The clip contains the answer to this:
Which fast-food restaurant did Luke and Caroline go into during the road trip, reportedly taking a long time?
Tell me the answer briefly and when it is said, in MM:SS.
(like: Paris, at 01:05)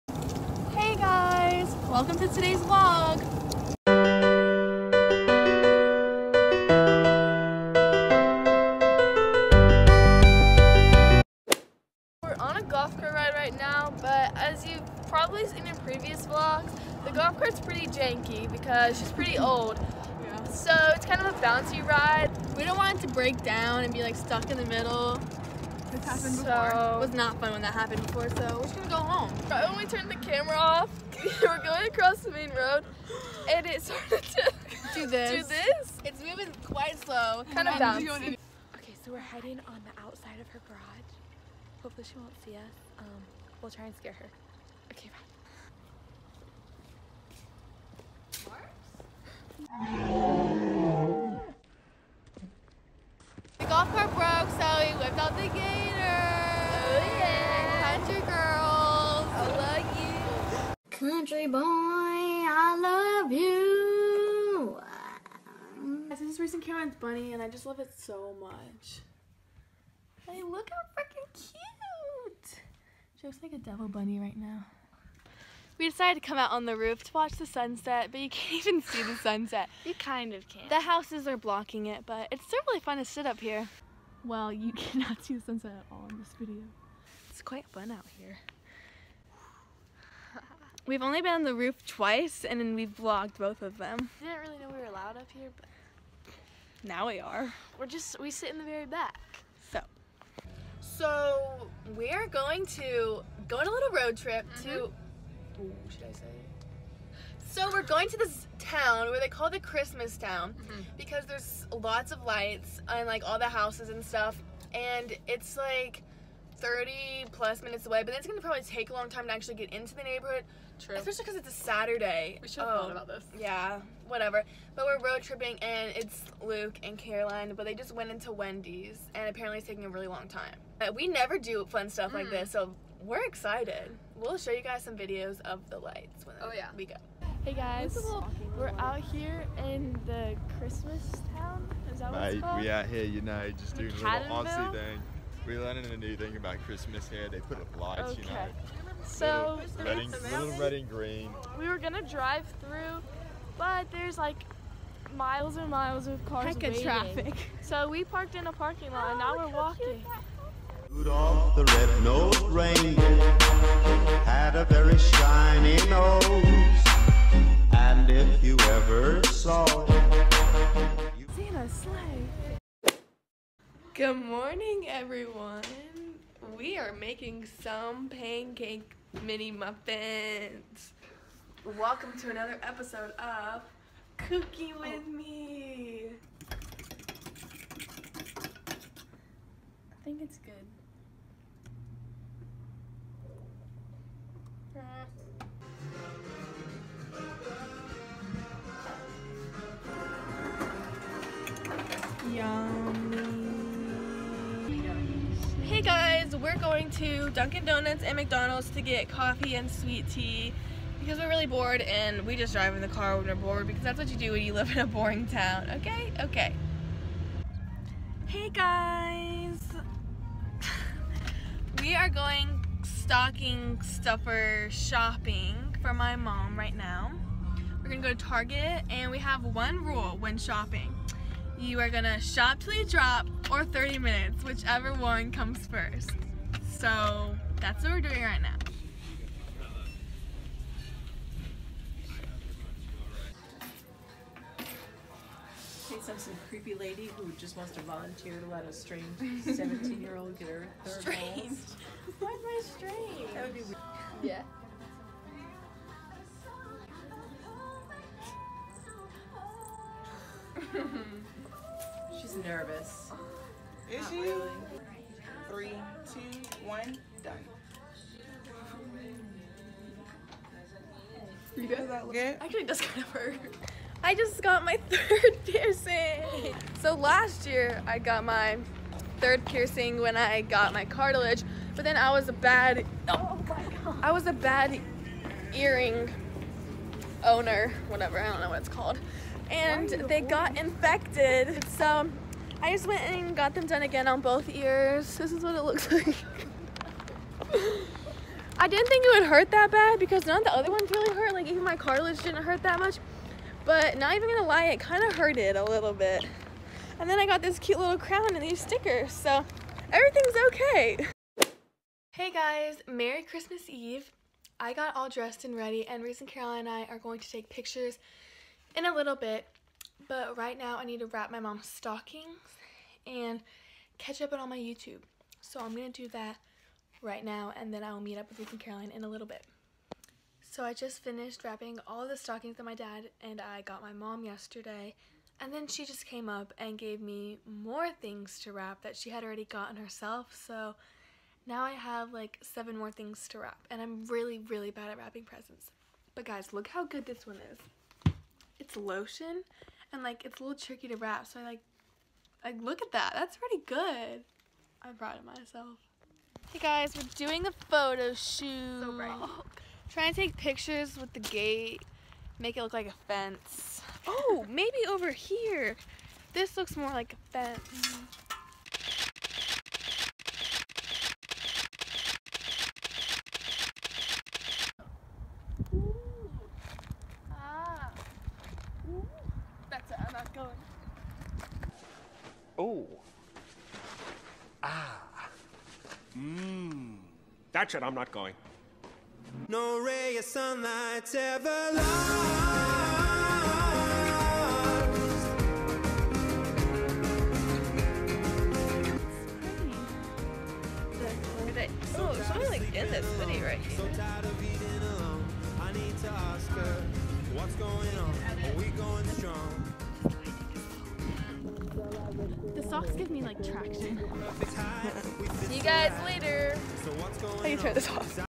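Wendy's, at 02:08.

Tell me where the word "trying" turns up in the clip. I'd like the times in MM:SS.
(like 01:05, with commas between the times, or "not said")
05:59.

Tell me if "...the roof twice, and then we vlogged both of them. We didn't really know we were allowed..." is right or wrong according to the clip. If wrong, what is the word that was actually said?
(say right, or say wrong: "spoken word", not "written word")
right.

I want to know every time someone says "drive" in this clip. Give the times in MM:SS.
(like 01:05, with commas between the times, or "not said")
02:32, 03:32.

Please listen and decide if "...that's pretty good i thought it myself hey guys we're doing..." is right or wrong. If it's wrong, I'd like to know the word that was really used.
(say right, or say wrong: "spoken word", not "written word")
wrong: "brought", not "thought".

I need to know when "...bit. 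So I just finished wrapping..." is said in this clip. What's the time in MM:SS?
05:29.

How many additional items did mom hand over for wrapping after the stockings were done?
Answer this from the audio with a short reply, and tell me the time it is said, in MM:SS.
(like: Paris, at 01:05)
7, at 05:42.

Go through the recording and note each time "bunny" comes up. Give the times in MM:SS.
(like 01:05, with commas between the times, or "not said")
01:06, 01:13.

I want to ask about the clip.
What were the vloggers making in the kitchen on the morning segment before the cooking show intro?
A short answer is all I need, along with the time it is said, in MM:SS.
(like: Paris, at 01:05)
pancake mini muffins, at 02:58.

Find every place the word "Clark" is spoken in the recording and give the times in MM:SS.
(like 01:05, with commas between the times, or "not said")
not said.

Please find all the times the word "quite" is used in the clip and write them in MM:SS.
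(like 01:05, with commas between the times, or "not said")
00:36, 01:27.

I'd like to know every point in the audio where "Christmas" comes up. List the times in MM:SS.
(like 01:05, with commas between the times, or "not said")
01:49, 02:20, 02:26, 05:13.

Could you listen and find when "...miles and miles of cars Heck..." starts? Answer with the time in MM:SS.
02:35.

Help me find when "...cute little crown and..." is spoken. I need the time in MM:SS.
05:07.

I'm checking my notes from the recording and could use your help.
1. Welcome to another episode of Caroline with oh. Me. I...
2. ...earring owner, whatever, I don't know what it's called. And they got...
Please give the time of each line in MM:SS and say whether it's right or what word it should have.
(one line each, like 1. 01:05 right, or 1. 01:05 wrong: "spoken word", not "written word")
1. 03:01 wrong: "Cookie", not "Caroline"
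2. 04:45 right.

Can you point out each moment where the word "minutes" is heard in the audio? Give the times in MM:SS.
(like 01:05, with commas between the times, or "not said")
01:57, 03:53.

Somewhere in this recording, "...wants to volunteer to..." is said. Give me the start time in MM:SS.
04:07.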